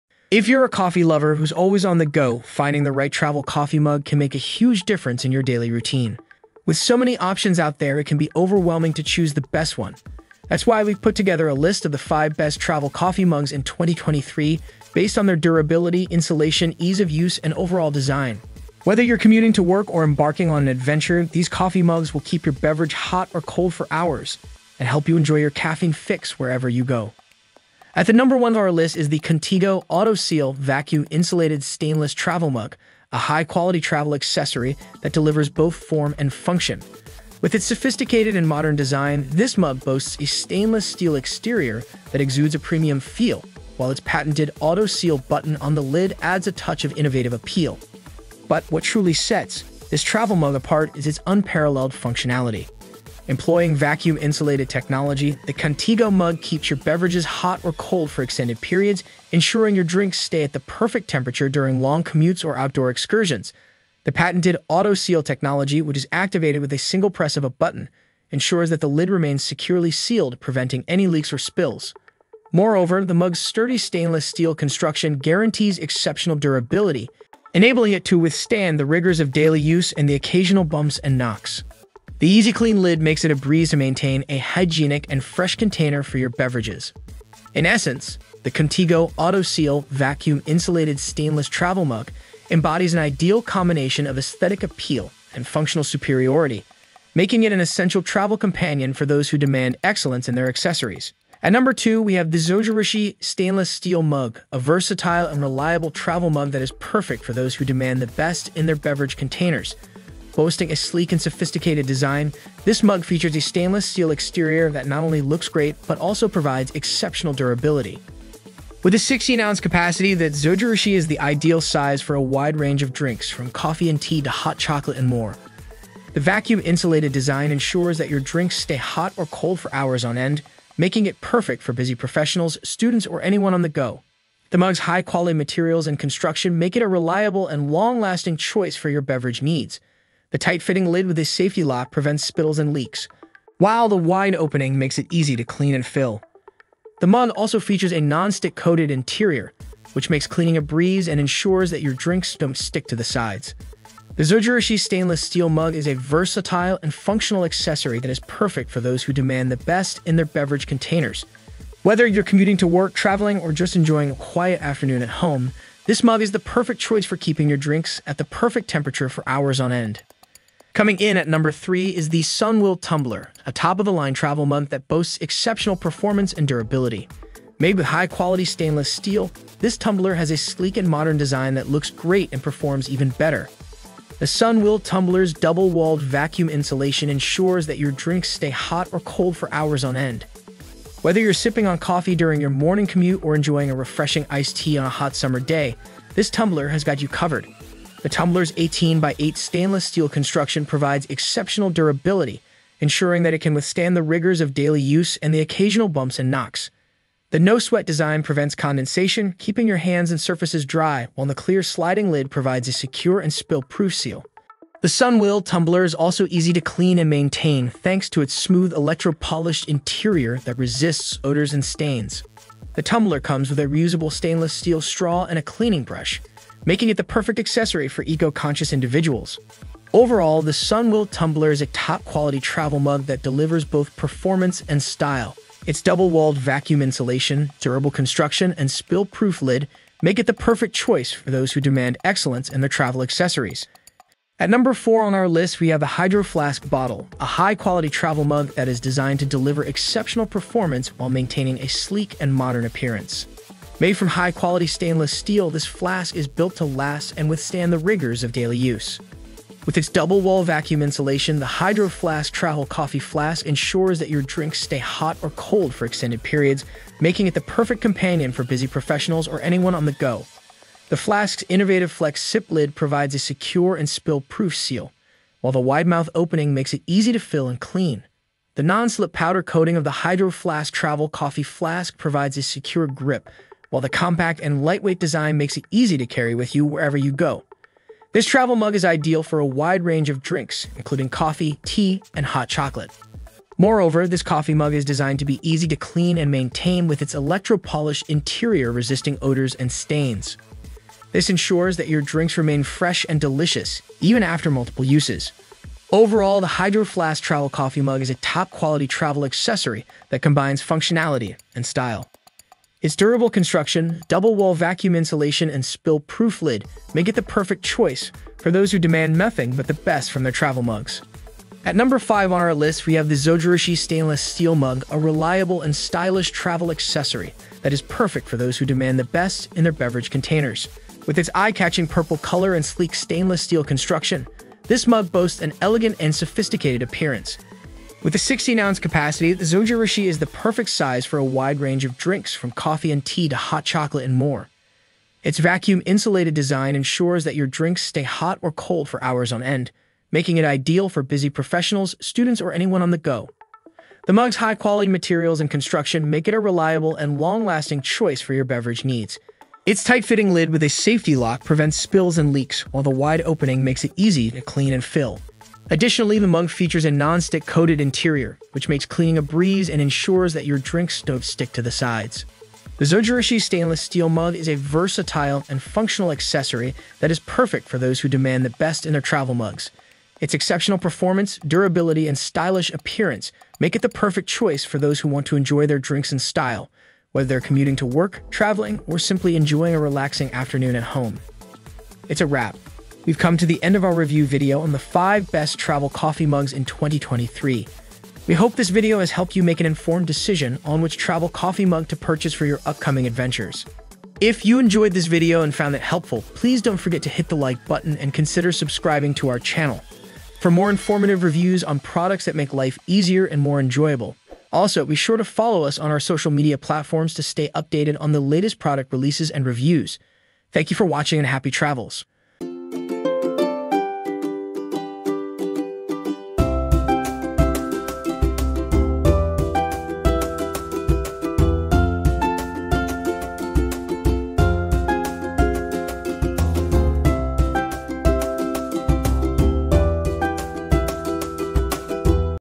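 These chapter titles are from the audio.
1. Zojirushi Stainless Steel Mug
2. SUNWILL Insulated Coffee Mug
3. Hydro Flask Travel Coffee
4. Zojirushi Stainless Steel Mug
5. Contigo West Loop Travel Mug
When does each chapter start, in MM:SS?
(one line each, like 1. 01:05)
1. 05:21
2. 02:51
3. 04:03
4. 01:41
5. 00:27.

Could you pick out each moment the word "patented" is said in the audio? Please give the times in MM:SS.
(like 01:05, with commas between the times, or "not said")
00:43, 01:04.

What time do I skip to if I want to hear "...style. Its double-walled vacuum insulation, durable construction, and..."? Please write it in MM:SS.
03:54.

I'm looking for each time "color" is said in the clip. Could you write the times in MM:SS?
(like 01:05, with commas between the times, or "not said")
05:32.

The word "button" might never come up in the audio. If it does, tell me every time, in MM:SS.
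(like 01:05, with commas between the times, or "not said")
00:45, 01:07, 06:47.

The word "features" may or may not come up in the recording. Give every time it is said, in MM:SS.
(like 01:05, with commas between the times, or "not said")
01:53, 02:27, 06:06.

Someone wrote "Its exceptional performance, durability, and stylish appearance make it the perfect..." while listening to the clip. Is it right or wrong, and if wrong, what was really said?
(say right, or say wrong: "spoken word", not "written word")
right.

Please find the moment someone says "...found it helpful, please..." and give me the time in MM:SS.
06:45.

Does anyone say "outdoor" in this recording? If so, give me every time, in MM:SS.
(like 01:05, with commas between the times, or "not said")
01:02.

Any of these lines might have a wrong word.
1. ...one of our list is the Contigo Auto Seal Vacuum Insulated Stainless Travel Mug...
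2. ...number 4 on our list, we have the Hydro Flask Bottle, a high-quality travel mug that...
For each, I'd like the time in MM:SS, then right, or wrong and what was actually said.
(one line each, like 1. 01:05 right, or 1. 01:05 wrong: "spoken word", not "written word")
1. 00:28 right
2. 04:04 right.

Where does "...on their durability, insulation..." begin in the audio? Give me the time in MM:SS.
00:15.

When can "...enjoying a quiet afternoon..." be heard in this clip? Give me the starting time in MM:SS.
02:43.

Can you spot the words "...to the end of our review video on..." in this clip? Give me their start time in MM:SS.
06:33.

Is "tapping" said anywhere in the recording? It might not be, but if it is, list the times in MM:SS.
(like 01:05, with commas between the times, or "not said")
not said.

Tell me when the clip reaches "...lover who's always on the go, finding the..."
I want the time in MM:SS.
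00:01.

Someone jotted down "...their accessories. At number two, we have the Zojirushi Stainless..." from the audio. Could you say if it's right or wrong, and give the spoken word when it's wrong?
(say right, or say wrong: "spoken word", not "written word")
right.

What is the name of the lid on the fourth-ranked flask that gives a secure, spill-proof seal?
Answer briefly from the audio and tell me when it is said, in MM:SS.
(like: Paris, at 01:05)
Flex Sip lid, at 04:31.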